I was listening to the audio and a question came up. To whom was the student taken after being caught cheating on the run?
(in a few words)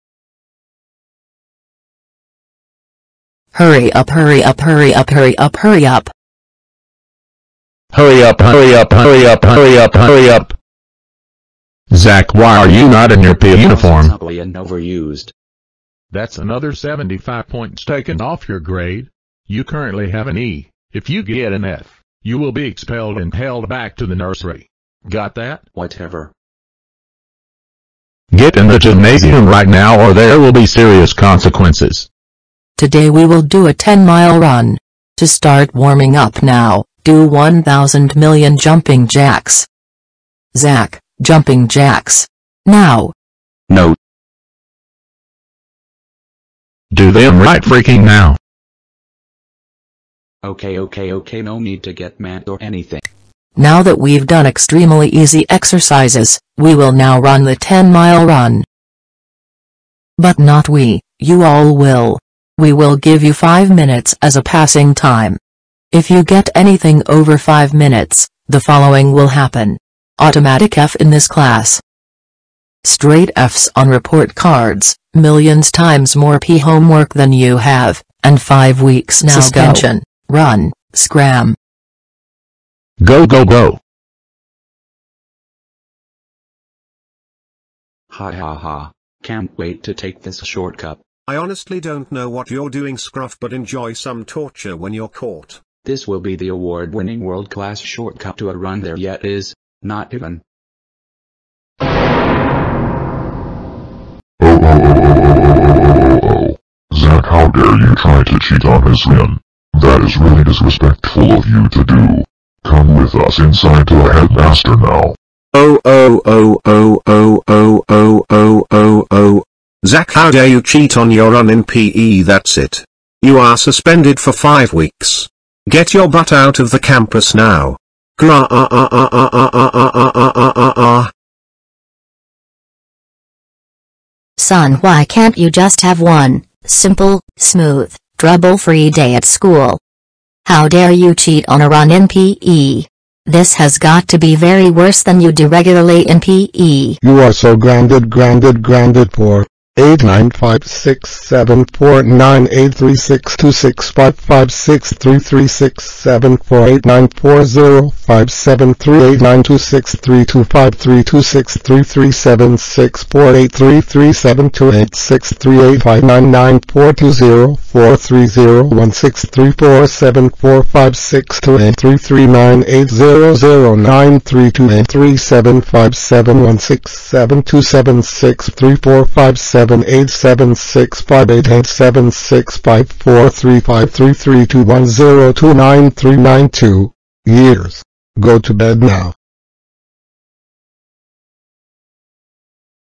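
The headmaster.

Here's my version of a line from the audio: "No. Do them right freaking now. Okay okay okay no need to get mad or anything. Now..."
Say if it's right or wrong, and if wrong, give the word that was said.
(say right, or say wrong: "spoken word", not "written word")
right.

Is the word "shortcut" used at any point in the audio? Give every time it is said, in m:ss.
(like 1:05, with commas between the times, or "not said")
1:30, 1:37.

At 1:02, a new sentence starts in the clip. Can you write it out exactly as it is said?
We will give you 5 minutes as a passing time.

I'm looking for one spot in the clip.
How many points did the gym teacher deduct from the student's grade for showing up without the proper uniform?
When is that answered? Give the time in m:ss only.
0:16.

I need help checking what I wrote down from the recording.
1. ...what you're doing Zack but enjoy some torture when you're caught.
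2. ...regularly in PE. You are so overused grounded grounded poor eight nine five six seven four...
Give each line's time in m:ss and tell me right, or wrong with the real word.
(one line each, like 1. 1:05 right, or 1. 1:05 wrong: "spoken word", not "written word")
1. 1:32 wrong: "Scruff", not "Zack"
2. 2:25 wrong: "grounded", not "overused".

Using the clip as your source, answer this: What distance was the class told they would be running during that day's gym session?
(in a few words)
10 miles.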